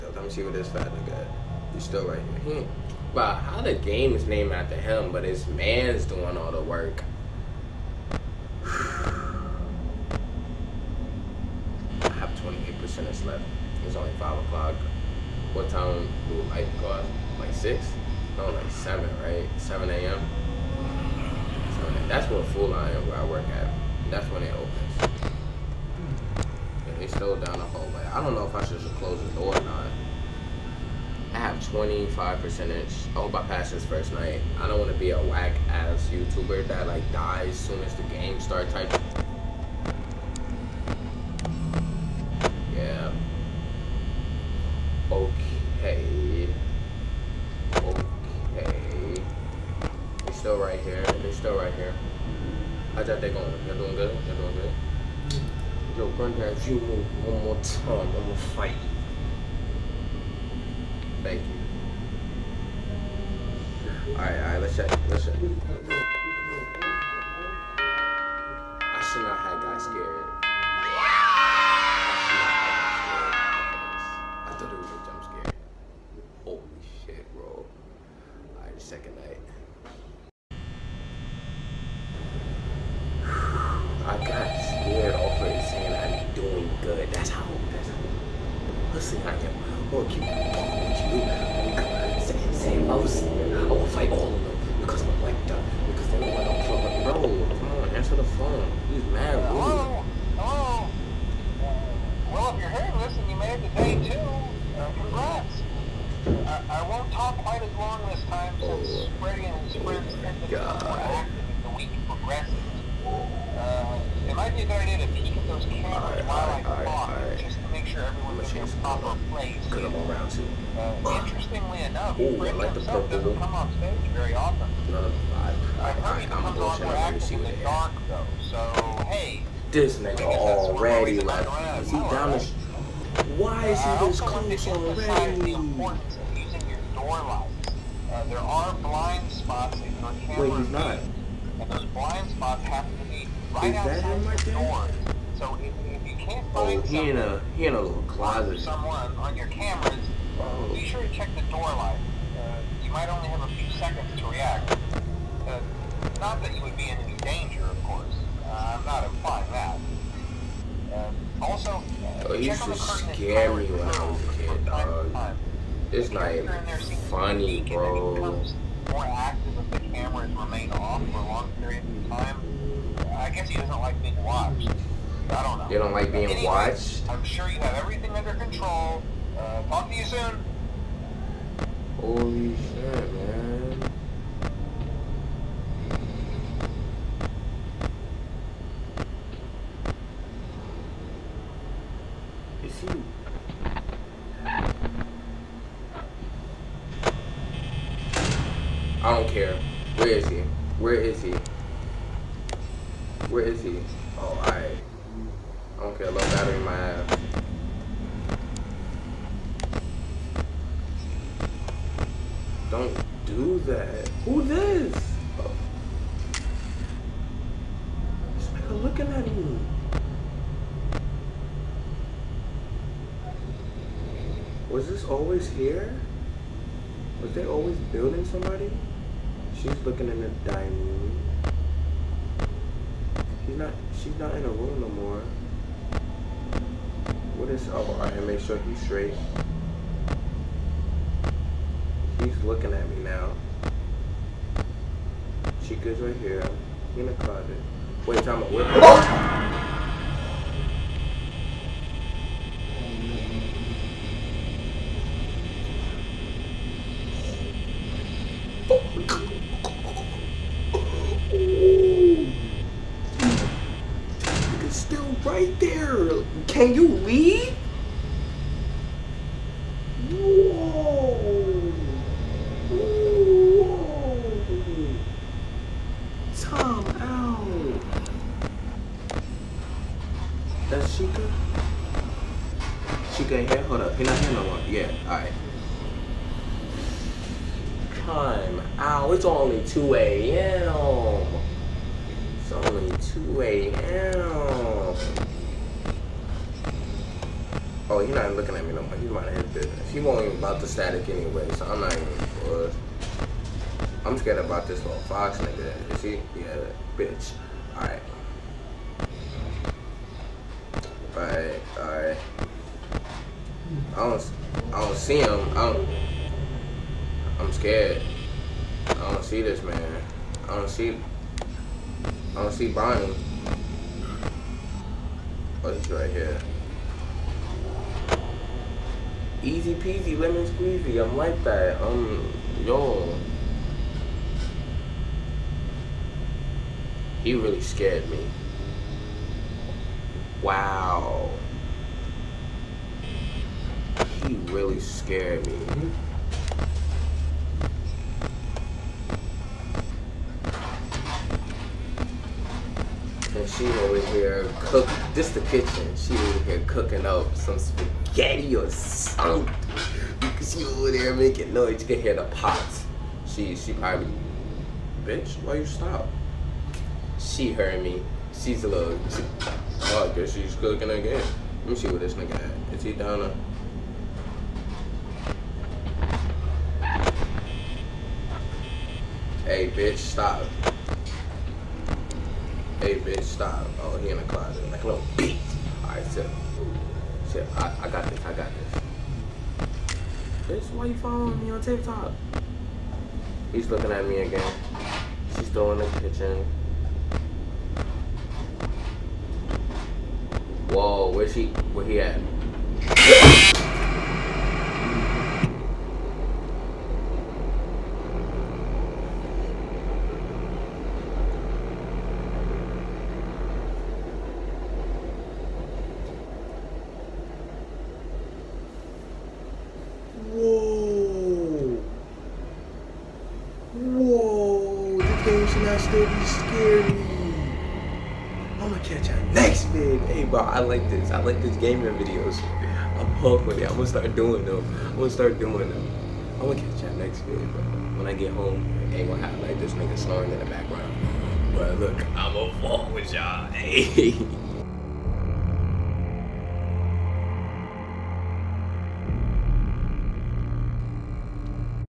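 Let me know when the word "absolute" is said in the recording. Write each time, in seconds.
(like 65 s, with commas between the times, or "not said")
not said.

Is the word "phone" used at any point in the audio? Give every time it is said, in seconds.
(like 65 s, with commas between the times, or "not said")
98 s.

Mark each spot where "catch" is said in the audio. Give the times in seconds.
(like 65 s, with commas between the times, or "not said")
428 s, 436 s.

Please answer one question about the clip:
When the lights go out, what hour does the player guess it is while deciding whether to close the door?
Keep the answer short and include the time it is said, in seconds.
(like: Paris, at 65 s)
6, at 17 s.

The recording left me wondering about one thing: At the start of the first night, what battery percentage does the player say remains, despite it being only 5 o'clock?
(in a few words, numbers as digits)
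28%.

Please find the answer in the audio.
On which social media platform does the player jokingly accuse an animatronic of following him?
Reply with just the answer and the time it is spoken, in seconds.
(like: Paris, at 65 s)
TikTok, at 391 s.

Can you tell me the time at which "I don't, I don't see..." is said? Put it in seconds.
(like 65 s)
313 s.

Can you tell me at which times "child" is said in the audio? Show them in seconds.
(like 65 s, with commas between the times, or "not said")
not said.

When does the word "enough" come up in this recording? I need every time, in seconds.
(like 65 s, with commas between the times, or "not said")
121 s.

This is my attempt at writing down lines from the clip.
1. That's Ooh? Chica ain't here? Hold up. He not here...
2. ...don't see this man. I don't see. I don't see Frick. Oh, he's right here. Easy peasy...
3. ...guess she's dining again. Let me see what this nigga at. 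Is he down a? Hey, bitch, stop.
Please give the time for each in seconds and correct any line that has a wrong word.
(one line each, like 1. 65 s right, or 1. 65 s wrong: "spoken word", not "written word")
1. 280 s wrong: "Chica", not "Ooh"
2. 319 s wrong: "Bonnie", not "Frick"
3. 370 s wrong: "cooking", not "dining".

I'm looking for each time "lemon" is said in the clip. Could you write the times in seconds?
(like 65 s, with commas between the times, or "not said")
330 s.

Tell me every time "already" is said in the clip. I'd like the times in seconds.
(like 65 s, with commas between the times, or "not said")
130 s, 134 s.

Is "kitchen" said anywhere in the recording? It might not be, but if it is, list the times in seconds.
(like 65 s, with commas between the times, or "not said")
355 s, 395 s.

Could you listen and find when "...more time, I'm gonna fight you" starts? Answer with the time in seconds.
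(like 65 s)
57 s.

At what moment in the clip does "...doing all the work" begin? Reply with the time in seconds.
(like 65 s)
6 s.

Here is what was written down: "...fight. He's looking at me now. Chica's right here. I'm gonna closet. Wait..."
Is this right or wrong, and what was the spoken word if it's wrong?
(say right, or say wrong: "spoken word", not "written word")
wrong: "straight", not "fight".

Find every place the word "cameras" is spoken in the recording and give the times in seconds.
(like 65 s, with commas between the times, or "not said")
115 s, 140 s, 149 s, 169 s.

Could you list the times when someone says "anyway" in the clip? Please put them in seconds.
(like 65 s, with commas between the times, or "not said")
176 s, 301 s.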